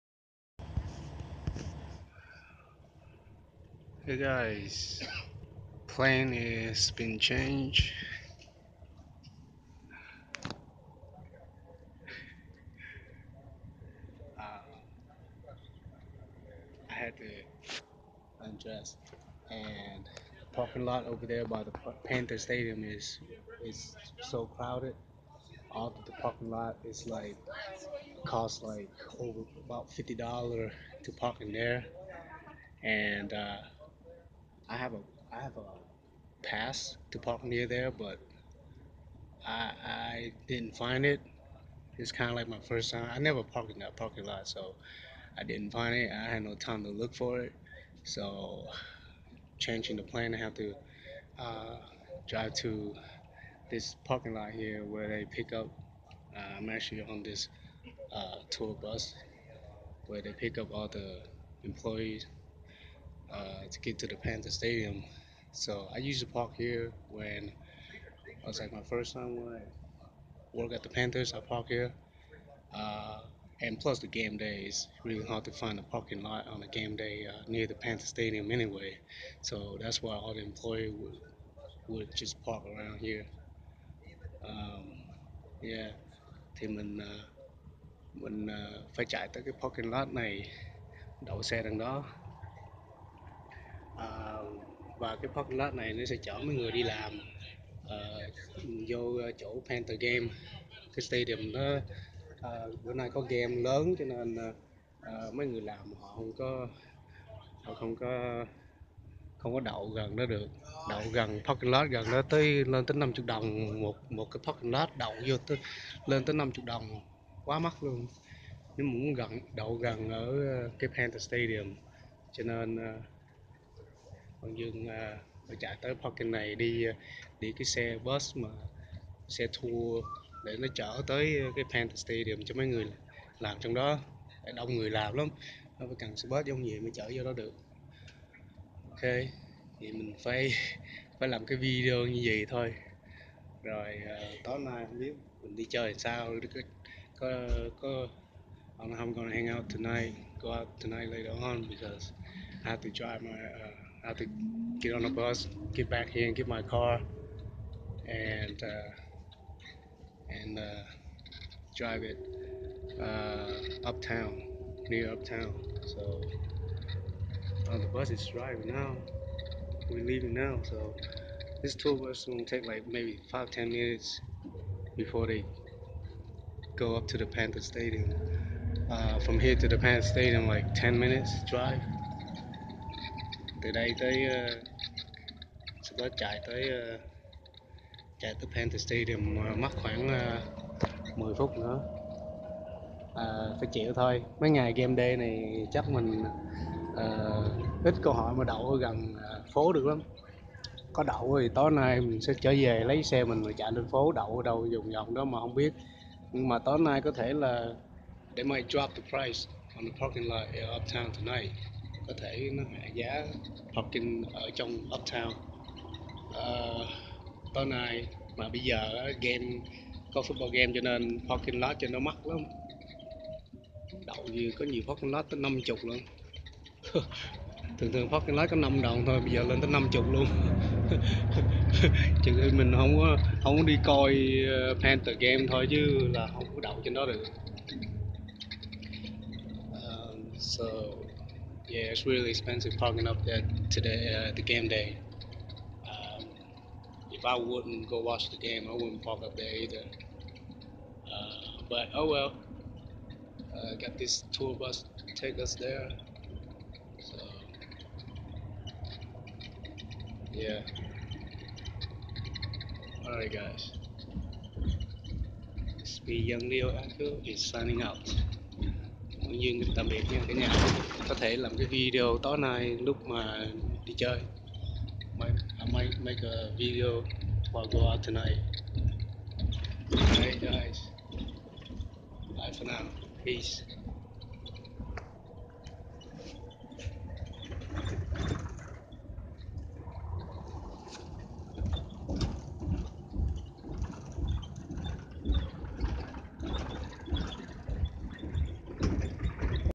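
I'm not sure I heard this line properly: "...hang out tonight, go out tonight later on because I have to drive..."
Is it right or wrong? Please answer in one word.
right.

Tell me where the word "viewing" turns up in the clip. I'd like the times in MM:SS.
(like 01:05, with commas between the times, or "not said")
not said.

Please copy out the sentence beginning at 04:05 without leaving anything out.
Um, if I wouldn't go watch the game, I wouldn't park up there either.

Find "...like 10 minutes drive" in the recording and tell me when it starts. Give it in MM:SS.
03:00.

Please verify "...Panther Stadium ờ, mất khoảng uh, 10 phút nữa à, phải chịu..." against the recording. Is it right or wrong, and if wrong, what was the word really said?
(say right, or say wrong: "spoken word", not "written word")
right.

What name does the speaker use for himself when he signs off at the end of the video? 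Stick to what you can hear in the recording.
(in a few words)
Young Leo Echo.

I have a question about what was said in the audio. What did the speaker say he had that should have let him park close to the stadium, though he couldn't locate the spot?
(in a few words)
a pass.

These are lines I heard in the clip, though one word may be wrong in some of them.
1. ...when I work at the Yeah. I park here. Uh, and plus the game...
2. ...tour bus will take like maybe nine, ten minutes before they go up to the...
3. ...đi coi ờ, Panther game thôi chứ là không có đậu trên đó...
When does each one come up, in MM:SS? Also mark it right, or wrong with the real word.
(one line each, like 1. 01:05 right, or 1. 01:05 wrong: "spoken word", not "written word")
1. 01:09 wrong: "Panthers", not "Yeah"
2. 02:51 wrong: "five", not "nine"
3. 03:53 right.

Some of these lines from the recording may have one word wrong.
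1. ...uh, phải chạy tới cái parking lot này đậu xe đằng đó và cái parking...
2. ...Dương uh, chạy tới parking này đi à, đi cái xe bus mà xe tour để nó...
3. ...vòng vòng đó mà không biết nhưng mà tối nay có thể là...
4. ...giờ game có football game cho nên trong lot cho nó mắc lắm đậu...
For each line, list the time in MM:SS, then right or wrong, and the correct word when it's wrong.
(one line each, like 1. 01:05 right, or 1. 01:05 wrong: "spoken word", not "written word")
1. 01:28 right
2. 02:04 right
3. 03:24 right
4. 03:38 wrong: "parking", not "trong".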